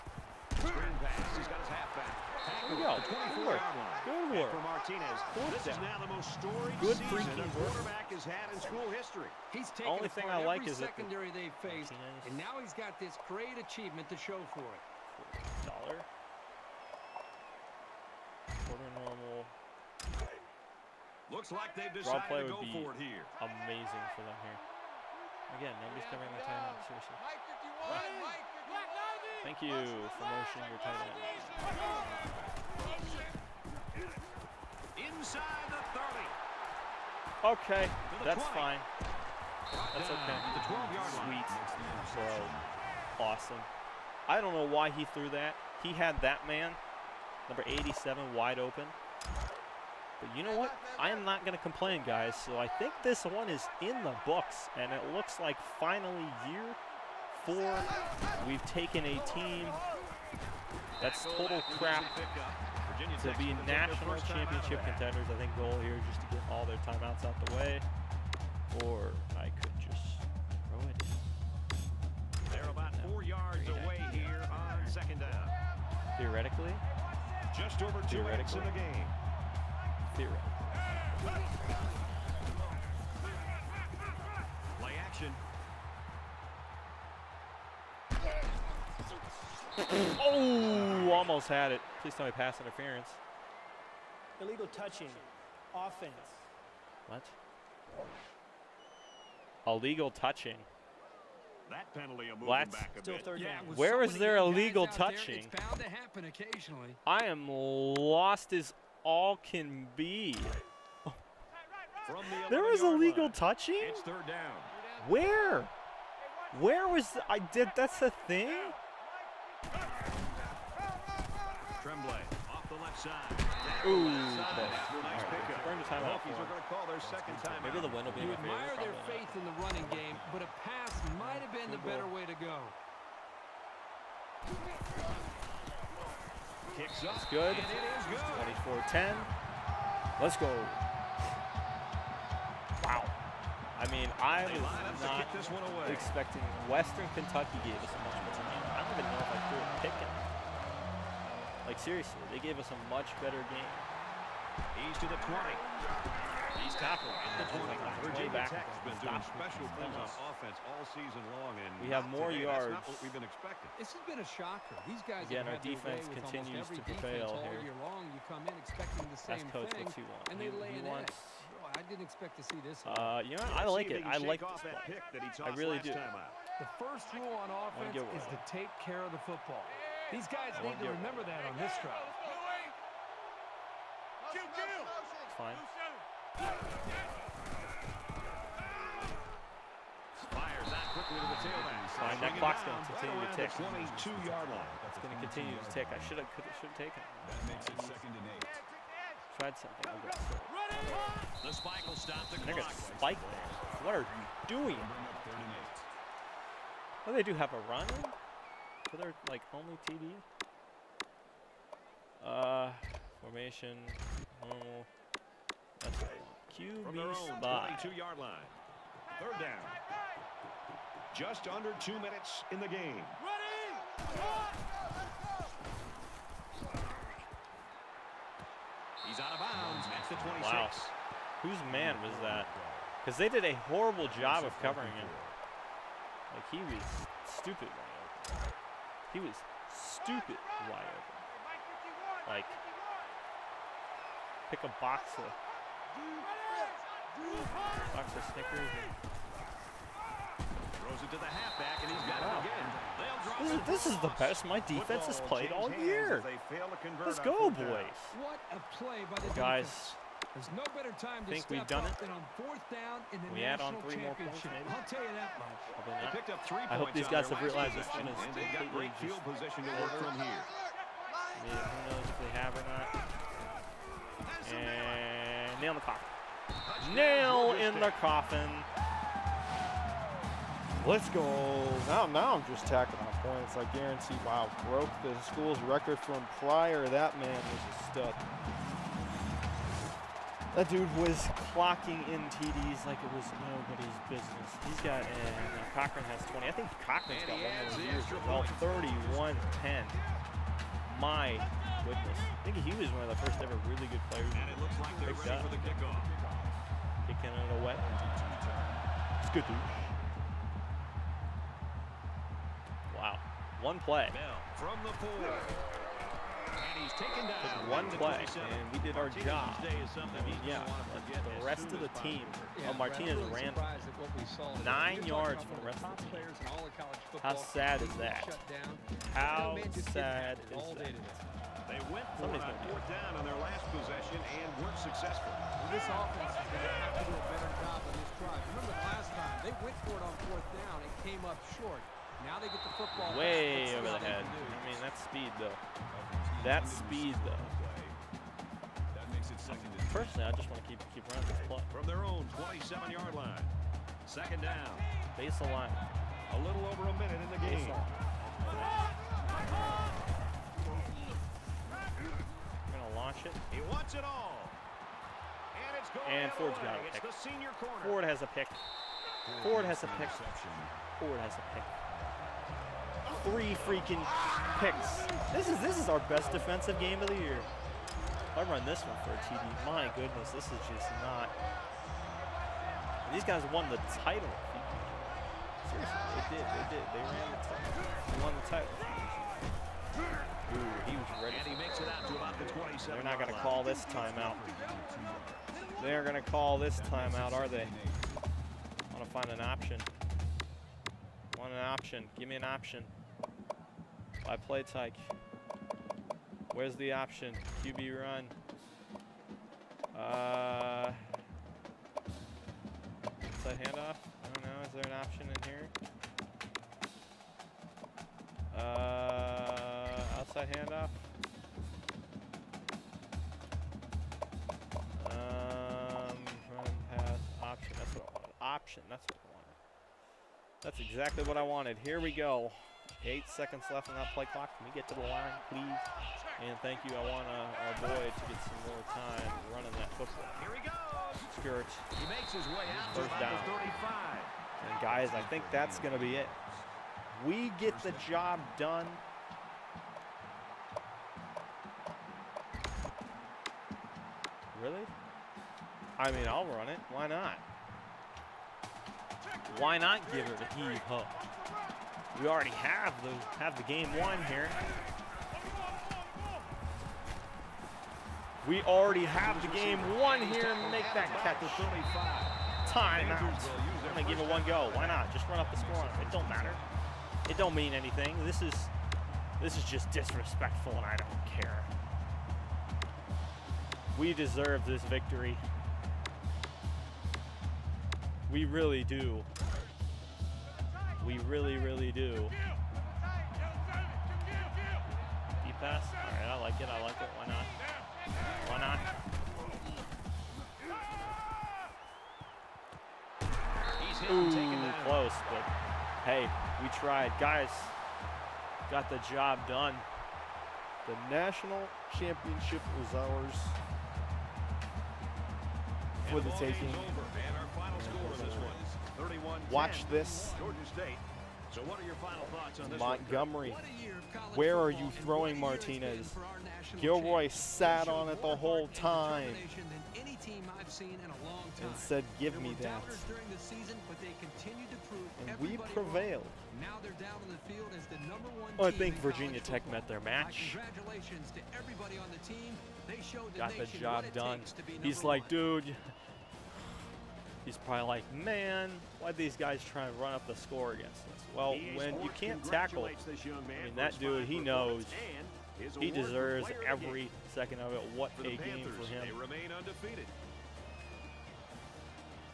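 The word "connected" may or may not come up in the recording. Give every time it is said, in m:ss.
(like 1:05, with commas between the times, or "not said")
not said.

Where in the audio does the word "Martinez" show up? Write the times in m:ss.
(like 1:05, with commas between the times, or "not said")
0:04, 0:11, 5:22, 8:45.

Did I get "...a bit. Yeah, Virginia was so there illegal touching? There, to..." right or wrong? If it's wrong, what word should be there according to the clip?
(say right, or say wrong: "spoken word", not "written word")
wrong: "Where", not "Virginia".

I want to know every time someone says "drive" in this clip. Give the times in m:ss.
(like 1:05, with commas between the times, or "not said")
3:01, 5:38.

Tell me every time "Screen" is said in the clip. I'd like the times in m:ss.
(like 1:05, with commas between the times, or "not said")
0:00.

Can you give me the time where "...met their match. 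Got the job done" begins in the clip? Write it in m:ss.
8:59.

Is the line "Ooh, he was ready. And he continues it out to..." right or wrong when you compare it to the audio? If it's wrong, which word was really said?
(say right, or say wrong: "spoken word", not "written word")
wrong: "makes", not "continues".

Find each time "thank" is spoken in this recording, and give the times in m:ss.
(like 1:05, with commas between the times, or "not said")
0:29, 7:16.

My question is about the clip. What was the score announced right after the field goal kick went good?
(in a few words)
24-10.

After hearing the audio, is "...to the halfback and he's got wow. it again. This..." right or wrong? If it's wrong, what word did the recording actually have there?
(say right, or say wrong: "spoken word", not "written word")
right.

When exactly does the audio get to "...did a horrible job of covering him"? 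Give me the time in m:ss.
3:53.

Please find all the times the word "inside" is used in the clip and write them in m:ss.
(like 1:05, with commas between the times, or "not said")
0:35, 6:53.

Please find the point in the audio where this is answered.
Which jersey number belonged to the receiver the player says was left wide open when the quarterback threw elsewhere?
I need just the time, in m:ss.
0:47.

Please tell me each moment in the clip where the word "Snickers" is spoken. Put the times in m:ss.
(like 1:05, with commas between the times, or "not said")
4:08.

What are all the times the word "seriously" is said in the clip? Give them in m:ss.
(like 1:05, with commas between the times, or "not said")
0:26, 2:31, 6:25.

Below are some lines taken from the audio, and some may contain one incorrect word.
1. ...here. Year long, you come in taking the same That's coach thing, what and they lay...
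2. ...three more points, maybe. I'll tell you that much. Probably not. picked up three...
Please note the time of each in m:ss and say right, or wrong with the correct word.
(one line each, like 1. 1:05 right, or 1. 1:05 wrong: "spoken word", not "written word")
1. 2:47 wrong: "expecting", not "taking"
2. 4:23 right.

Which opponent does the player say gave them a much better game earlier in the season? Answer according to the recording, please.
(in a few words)
Western Kentucky.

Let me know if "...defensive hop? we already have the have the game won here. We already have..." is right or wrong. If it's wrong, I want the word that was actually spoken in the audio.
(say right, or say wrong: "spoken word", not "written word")
wrong: "heave", not "defensive".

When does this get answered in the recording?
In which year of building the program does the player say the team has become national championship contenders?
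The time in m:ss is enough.
0:56.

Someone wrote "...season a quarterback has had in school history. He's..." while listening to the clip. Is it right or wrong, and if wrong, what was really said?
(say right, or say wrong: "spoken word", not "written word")
right.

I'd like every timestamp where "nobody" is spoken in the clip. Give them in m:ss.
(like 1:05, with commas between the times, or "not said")
0:25, 4:53.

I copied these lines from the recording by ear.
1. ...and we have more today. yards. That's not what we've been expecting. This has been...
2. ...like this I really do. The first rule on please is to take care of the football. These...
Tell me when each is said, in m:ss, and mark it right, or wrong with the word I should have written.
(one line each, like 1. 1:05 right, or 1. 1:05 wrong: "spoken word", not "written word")
1. 2:41 right
2. 2:54 wrong: "offense", not "please".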